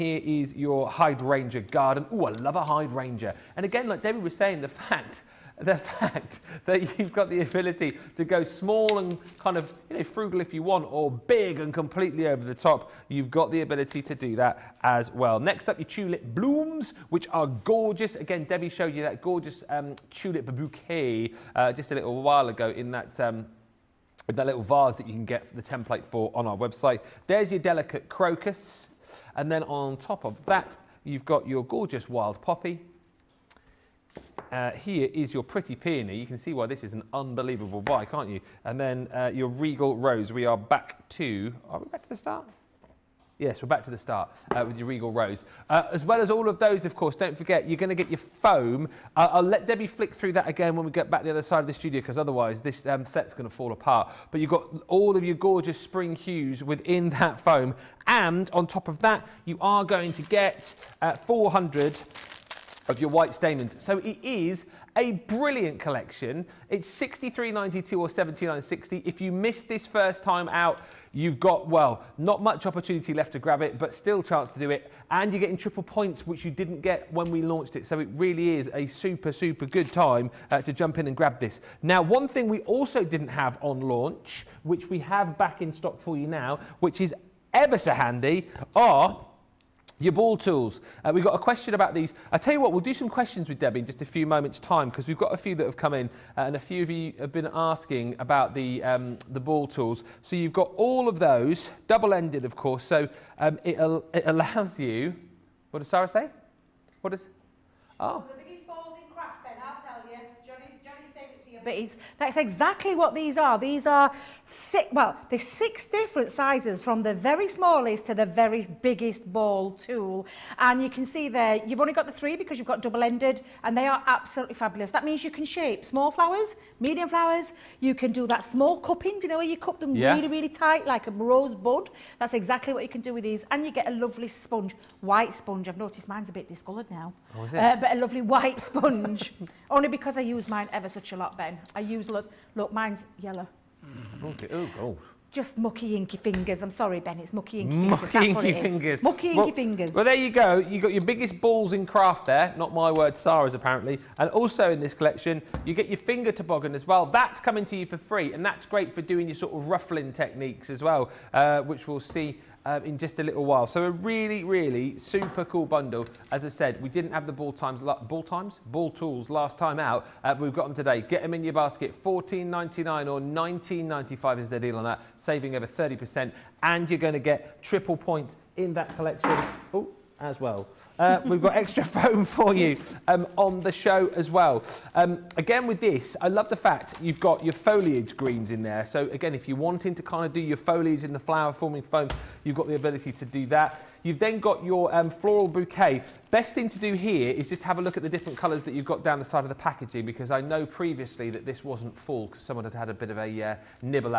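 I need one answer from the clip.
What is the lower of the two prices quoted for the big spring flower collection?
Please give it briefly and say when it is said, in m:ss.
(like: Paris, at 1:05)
63.92, at 1:06.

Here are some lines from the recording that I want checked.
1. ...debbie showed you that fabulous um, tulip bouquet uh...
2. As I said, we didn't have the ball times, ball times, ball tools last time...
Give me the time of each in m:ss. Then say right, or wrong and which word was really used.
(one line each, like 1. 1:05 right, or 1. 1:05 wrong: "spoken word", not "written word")
1. 0:18 wrong: "gorgeous", not "fabulous"
2. 2:46 right.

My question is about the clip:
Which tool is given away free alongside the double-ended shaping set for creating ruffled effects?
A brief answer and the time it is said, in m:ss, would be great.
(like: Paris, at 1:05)
finger toboggan, at 2:35.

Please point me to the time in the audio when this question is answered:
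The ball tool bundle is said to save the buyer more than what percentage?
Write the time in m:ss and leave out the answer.
2:55.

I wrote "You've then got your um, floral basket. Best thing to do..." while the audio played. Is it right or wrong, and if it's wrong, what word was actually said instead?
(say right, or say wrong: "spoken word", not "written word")
wrong: "bouquet", not "basket".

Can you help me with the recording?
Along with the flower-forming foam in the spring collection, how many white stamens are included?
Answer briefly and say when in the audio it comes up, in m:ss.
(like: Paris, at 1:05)
400, at 1:01.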